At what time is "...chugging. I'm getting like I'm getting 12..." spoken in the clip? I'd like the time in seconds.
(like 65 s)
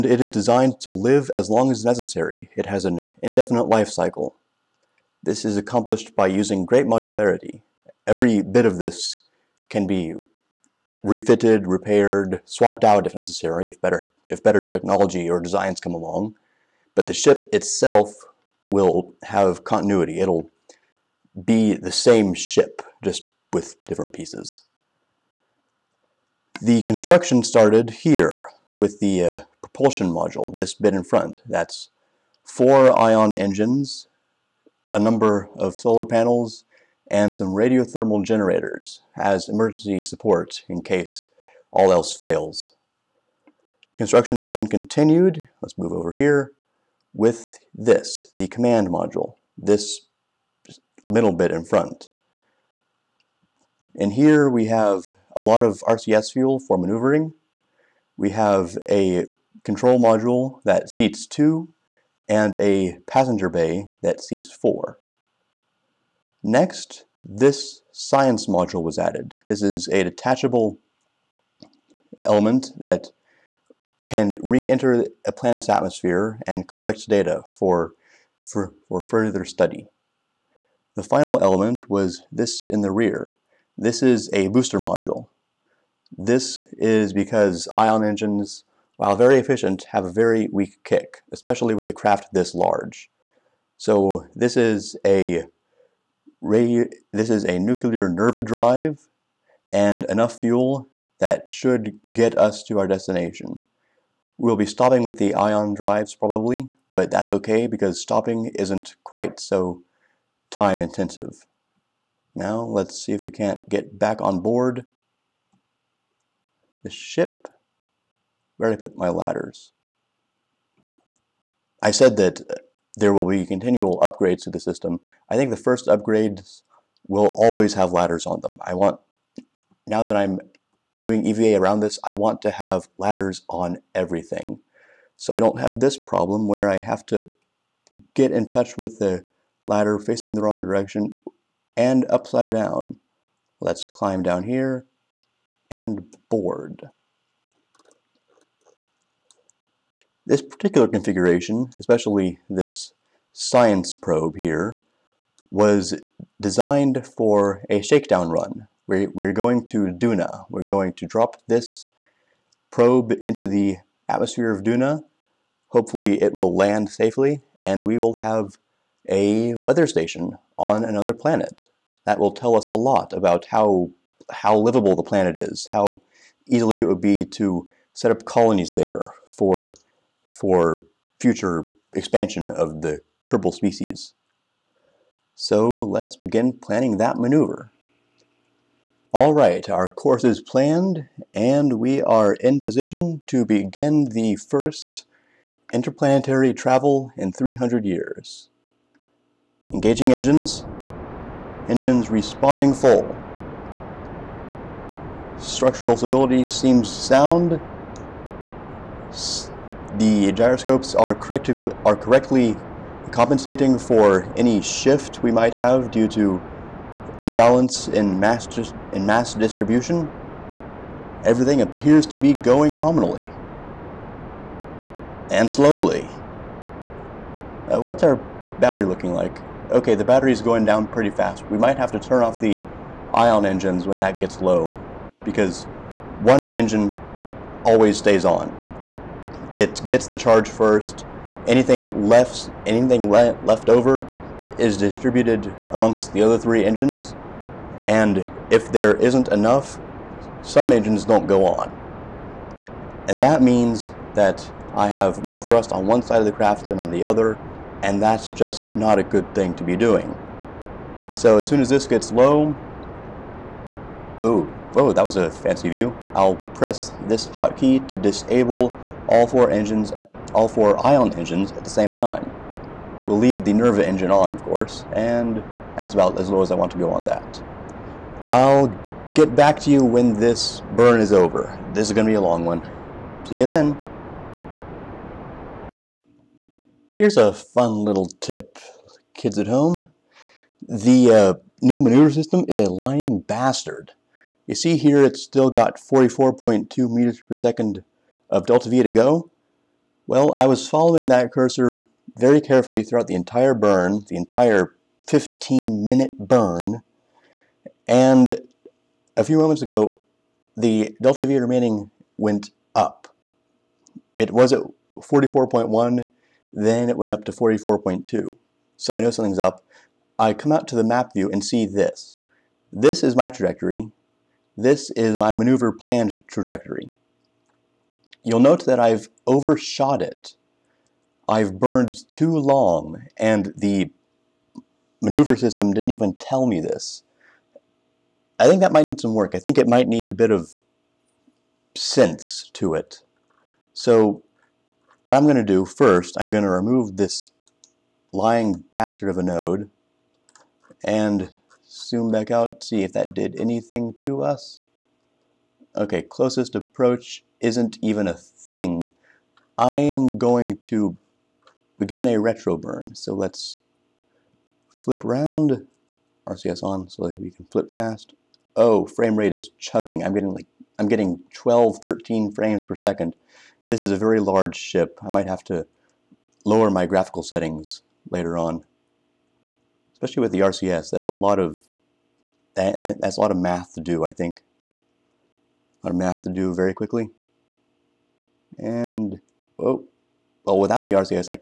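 369 s.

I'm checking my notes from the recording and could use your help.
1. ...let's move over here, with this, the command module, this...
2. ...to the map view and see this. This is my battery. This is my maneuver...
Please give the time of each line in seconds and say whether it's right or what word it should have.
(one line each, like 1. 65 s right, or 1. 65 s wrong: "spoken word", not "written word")
1. 45 s right
2. 320 s wrong: "trajectory", not "battery".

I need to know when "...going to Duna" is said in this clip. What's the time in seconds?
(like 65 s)
159 s.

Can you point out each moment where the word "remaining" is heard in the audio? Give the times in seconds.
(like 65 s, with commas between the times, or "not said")
311 s.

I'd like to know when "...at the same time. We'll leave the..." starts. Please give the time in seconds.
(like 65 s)
271 s.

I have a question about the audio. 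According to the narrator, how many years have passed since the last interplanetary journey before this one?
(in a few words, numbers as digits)
300.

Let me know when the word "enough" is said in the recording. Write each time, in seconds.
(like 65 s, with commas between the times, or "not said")
100 s, 249 s.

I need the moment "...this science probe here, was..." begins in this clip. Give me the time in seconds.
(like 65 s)
152 s.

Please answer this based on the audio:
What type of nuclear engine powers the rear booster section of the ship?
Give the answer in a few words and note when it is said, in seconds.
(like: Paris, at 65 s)
Nerva drive, at 97 s.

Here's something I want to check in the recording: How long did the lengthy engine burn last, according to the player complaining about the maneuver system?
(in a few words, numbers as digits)
15 minutes.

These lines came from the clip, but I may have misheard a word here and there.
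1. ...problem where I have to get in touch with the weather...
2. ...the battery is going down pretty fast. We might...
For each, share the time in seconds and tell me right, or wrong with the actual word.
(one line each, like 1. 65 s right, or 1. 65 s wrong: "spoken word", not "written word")
1. 135 s wrong: "ladder", not "weather"
2. 229 s right.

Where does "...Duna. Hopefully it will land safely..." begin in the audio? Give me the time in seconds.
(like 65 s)
164 s.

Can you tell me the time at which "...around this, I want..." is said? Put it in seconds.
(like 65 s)
131 s.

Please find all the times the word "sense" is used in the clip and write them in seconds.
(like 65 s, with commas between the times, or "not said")
341 s.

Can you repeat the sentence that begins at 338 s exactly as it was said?
I think that might need some work.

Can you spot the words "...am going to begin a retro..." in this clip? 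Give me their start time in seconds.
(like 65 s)
359 s.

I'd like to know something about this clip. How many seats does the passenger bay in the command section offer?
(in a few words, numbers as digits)
4.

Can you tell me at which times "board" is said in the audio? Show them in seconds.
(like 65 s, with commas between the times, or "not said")
114 s, 146 s.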